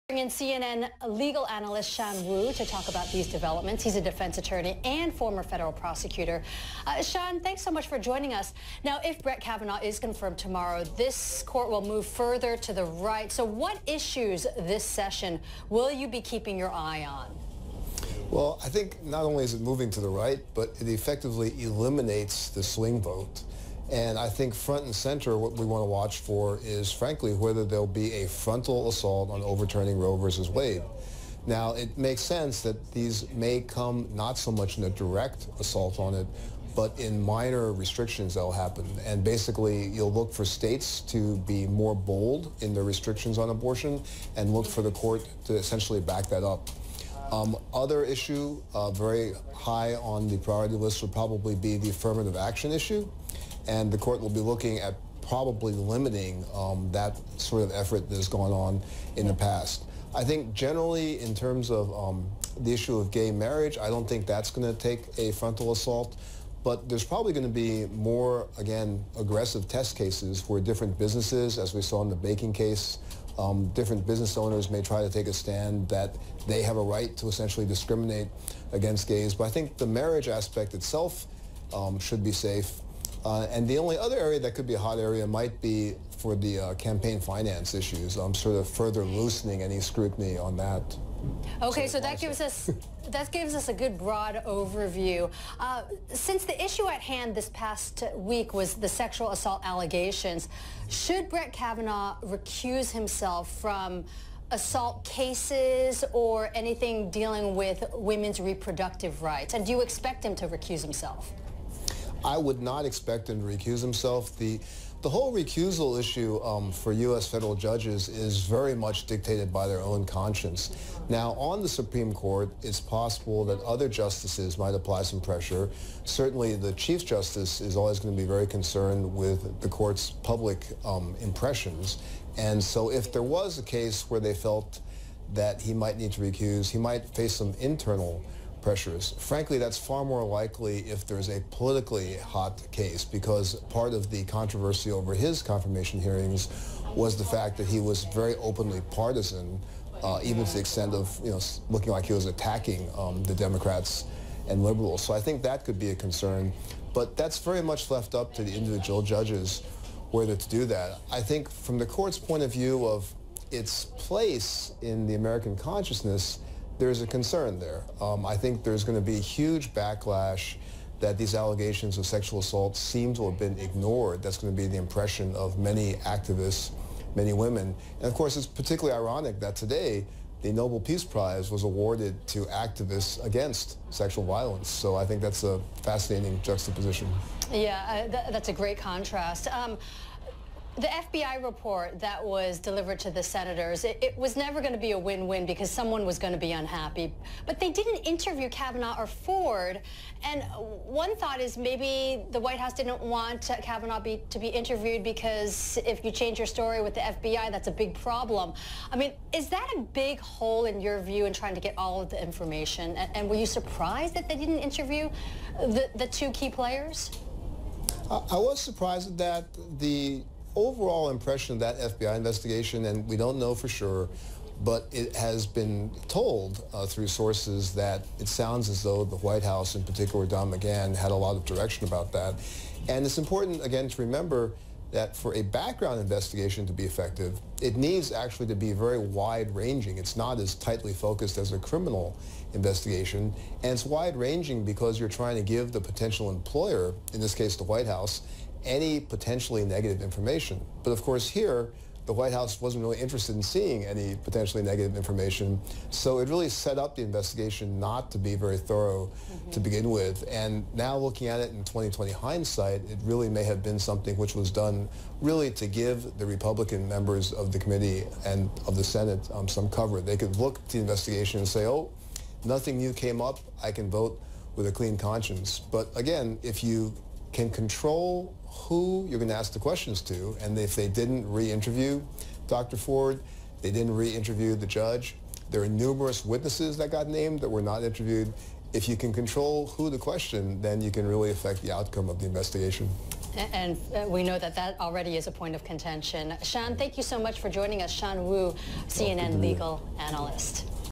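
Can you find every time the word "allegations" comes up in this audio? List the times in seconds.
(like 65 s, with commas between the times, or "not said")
99 s, 171 s.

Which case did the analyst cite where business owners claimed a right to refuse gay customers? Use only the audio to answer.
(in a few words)
the baking case.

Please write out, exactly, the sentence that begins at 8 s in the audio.
Now, if Brett Kavanaugh is confirmed tomorrow, this court will move further to the right.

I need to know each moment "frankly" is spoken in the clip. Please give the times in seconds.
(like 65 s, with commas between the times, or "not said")
26 s, 139 s.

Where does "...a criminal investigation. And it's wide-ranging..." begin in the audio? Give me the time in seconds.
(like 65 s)
241 s.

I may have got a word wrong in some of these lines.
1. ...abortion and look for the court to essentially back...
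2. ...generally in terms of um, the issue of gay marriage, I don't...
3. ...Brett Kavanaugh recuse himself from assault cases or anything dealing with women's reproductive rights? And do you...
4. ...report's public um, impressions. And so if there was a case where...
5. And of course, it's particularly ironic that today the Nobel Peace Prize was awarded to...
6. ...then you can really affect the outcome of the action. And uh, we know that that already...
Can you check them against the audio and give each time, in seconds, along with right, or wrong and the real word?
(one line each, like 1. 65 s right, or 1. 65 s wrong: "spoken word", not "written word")
1. 43 s right
2. 60 s right
3. 101 s right
4. 129 s wrong: "court", not "report"
5. 177 s right
6. 290 s wrong: "investigation", not "action".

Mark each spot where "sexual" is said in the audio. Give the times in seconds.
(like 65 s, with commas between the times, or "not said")
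98 s, 172 s, 183 s.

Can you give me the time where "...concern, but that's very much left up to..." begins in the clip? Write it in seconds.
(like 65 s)
155 s.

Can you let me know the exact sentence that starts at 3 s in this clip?
He's a defense attorney and former federal prosecutor.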